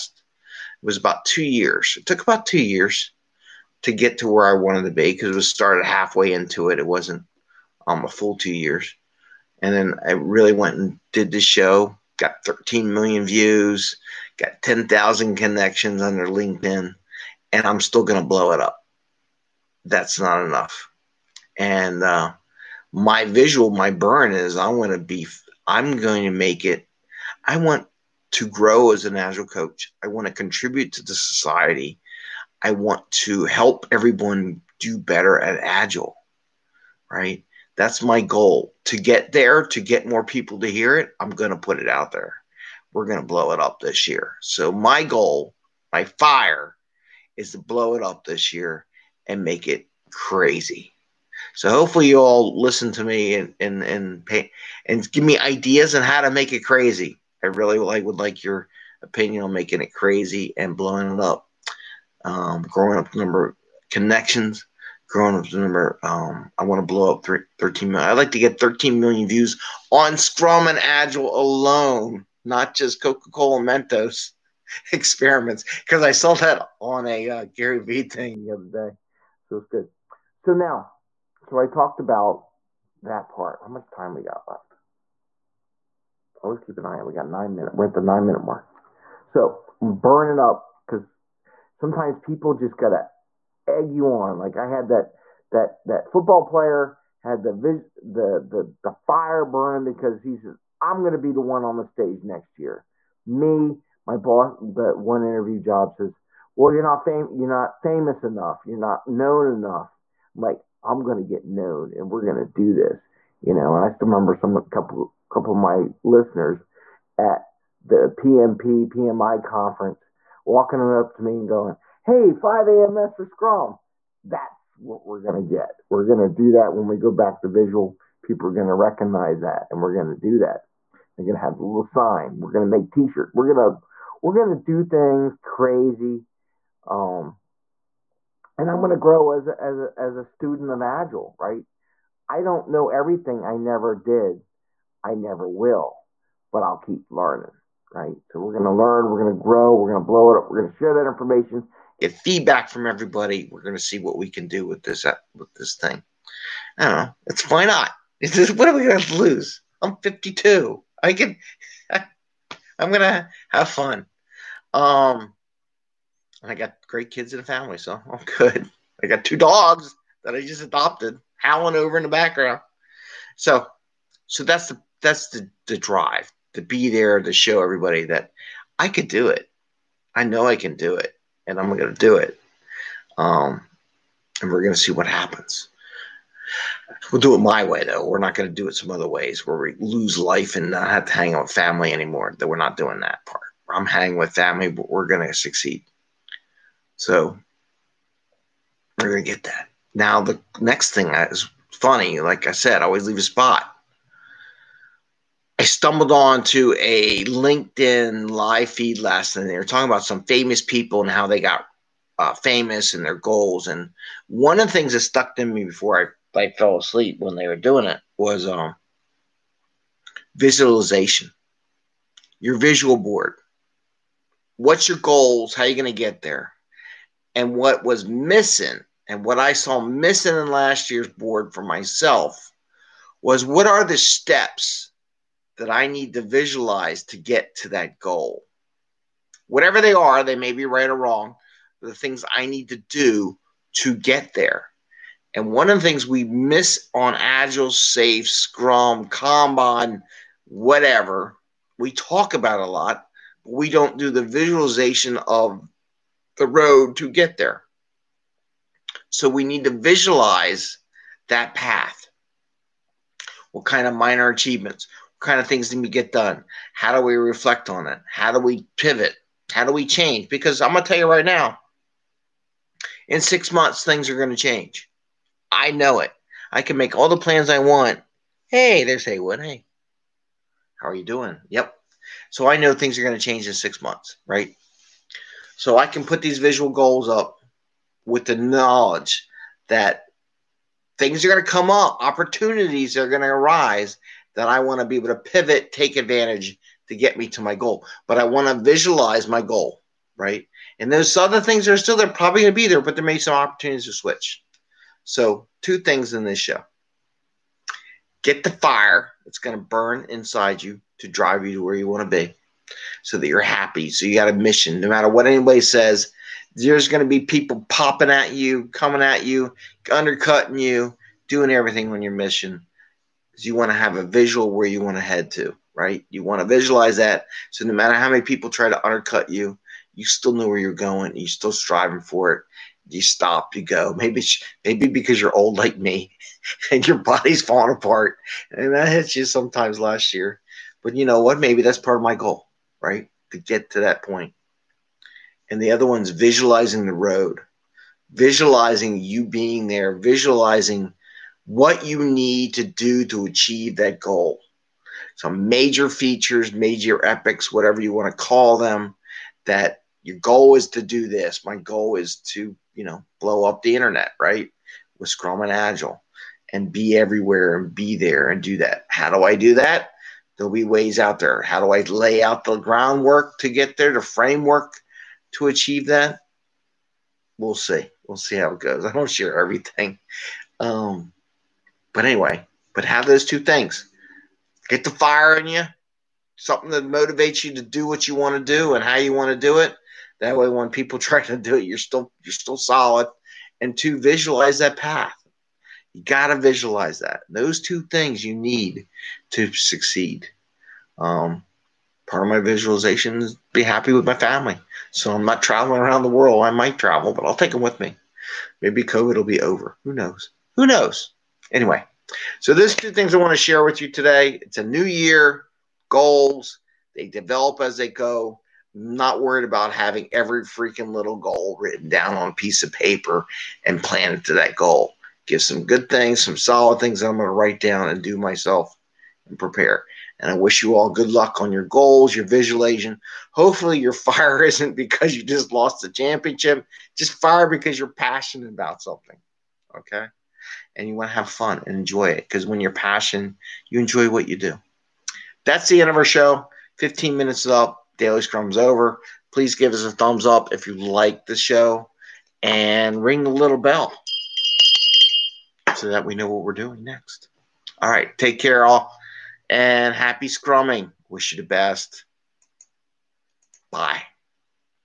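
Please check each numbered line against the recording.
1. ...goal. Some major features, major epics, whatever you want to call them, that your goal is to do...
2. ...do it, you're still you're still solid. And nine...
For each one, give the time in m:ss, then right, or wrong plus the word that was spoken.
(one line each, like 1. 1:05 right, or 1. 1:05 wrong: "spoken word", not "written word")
1. 5:54 right
2. 6:31 wrong: "two", not "nine".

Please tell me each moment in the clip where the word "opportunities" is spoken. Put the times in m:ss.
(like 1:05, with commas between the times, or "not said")
4:52, 5:03.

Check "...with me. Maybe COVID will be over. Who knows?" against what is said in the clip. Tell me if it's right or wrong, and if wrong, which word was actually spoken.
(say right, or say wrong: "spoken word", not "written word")
right.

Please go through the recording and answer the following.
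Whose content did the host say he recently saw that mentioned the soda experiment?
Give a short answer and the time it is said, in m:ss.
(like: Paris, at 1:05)
Gary Vee, at 1:17.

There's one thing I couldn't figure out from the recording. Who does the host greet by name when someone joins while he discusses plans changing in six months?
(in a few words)
Haywood.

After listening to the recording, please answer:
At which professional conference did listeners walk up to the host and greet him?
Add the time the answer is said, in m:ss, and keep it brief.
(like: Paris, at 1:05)
PMP PMI conference, at 1:58.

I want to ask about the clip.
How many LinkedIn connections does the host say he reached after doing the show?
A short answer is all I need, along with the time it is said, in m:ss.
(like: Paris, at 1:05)
10,000, at 0:14.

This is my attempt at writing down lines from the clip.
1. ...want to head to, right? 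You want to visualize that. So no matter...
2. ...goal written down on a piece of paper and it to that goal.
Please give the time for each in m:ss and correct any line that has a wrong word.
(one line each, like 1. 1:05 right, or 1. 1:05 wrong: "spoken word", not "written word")
1. 5:24 right
2. 7:01 right.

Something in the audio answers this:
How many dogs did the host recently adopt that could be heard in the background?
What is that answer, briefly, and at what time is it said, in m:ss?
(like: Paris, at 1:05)
2, at 2:49.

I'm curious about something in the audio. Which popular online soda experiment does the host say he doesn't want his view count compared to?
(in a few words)
Coca Cola Mentos.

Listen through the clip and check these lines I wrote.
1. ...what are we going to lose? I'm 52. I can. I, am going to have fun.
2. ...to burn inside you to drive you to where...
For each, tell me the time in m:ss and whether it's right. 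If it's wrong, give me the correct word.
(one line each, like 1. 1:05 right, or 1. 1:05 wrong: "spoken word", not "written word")
1. 2:38 right
2. 5:09 right.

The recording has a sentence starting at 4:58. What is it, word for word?
But I want to visualize my goal, right?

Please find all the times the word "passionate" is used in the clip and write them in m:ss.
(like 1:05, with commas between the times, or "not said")
7:17, 7:22.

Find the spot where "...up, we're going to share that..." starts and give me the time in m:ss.
2:30.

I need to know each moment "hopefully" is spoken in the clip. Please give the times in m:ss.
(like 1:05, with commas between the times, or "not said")
0:51, 7:13.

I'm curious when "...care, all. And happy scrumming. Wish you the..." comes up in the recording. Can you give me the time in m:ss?
7:38.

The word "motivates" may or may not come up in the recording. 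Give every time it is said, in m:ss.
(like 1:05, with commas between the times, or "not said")
6:26.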